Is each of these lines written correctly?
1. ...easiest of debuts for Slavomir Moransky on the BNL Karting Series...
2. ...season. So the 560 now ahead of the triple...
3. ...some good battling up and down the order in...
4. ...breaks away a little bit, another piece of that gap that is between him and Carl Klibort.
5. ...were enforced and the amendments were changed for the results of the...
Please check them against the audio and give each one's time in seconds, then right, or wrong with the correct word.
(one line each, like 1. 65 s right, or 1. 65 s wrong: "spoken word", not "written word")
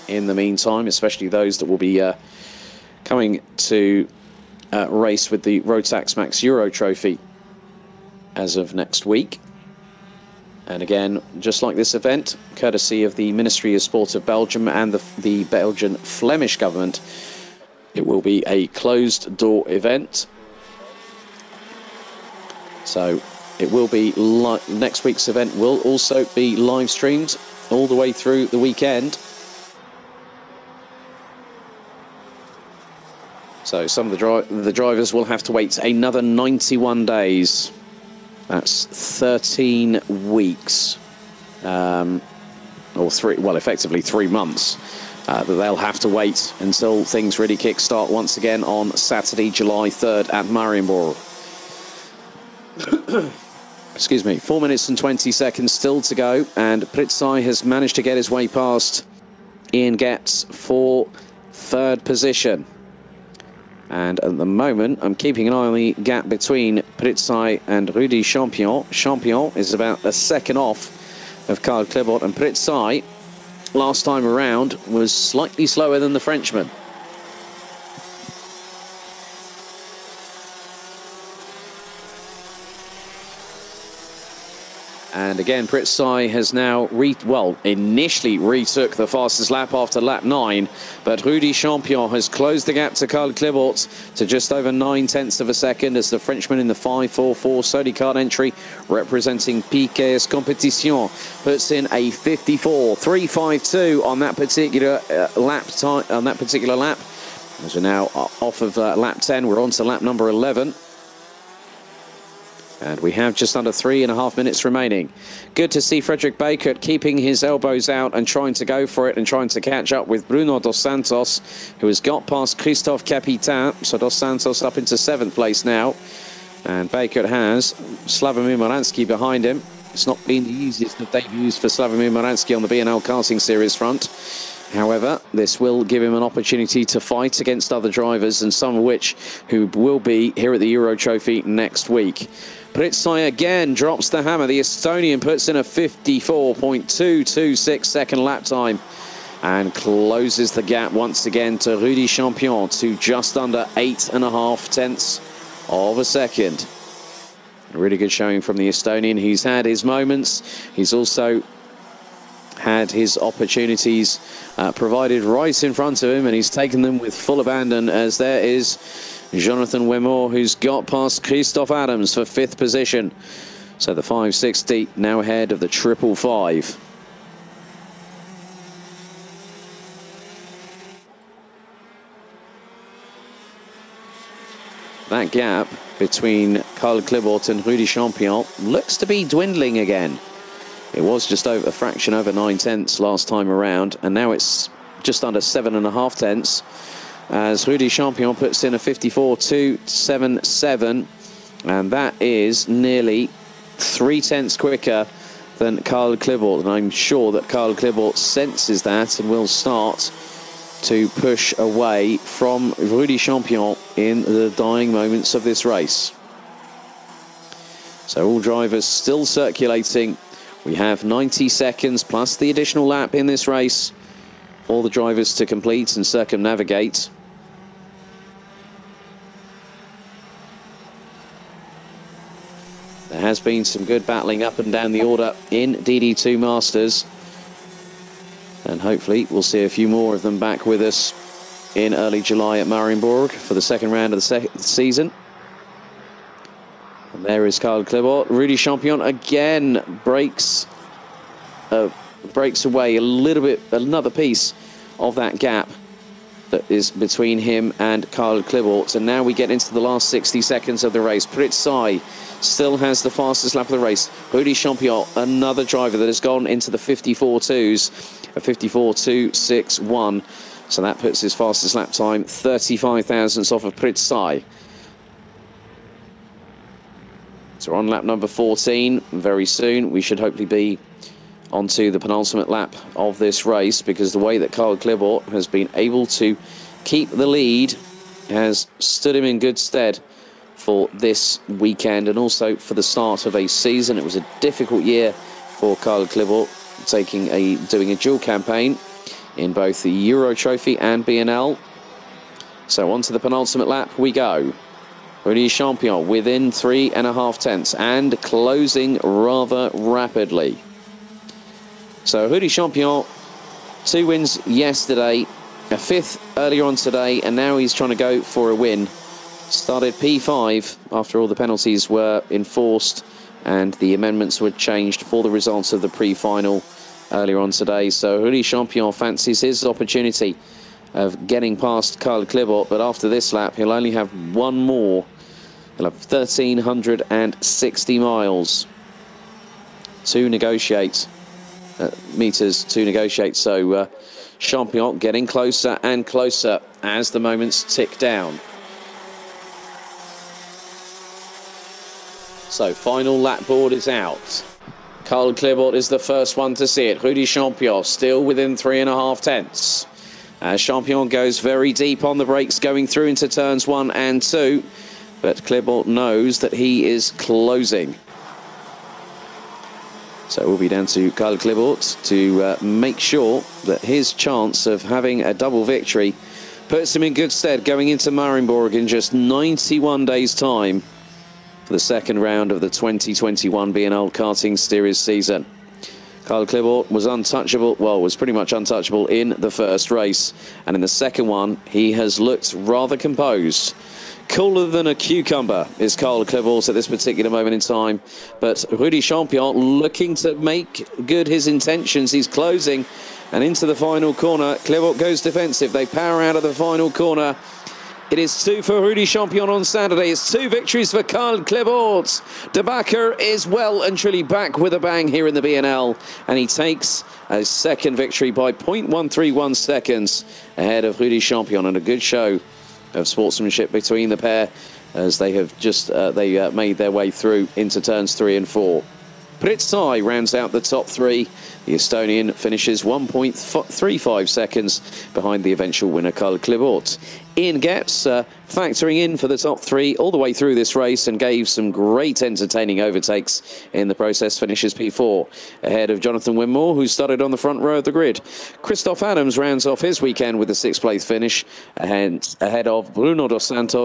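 1. 130 s right
2. 172 s wrong: "position", not "season"
3. 233 s right
4. 252 s right
5. 321 s right.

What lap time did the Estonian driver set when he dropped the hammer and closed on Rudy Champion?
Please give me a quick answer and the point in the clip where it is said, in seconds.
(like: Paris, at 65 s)
54.226, at 145 s.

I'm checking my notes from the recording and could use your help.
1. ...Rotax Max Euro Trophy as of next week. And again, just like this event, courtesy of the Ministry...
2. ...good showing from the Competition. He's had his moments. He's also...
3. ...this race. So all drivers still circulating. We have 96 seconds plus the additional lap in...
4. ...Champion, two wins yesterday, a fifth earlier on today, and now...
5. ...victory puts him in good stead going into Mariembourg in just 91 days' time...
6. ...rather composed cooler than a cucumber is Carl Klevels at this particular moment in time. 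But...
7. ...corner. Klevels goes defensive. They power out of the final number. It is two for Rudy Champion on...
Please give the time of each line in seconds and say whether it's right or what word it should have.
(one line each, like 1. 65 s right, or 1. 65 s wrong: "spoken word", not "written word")
1. 5 s right
2. 157 s wrong: "Estonian", not "Competition"
3. 215 s wrong: "90", not "96"
4. 312 s right
5. 375 s right
6. 392 s right
7. 404 s wrong: "corner", not "number".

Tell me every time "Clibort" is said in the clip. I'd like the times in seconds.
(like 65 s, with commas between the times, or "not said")
187 s, 284 s, 296 s.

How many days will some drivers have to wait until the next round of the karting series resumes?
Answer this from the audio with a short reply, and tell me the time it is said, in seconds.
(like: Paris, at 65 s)
91, at 36 s.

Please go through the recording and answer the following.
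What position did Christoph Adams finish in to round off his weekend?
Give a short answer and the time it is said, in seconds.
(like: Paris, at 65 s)
Sixth, at 450 s.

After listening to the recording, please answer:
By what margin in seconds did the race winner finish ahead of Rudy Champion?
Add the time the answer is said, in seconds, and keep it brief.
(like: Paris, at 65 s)
0.131, at 418 s.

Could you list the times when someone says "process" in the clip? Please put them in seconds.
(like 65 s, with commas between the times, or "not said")
443 s.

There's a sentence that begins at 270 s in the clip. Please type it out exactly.
So that puts his fastest lap time 35 thousandths off of Pritzai.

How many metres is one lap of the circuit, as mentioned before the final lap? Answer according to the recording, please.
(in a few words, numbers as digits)
1,360.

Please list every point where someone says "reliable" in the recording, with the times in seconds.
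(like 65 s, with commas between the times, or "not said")
not said.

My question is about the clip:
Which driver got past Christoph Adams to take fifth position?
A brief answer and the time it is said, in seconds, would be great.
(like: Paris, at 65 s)
Jonathan Wimore, at 169 s.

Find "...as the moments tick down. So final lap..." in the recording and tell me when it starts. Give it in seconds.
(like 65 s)
346 s.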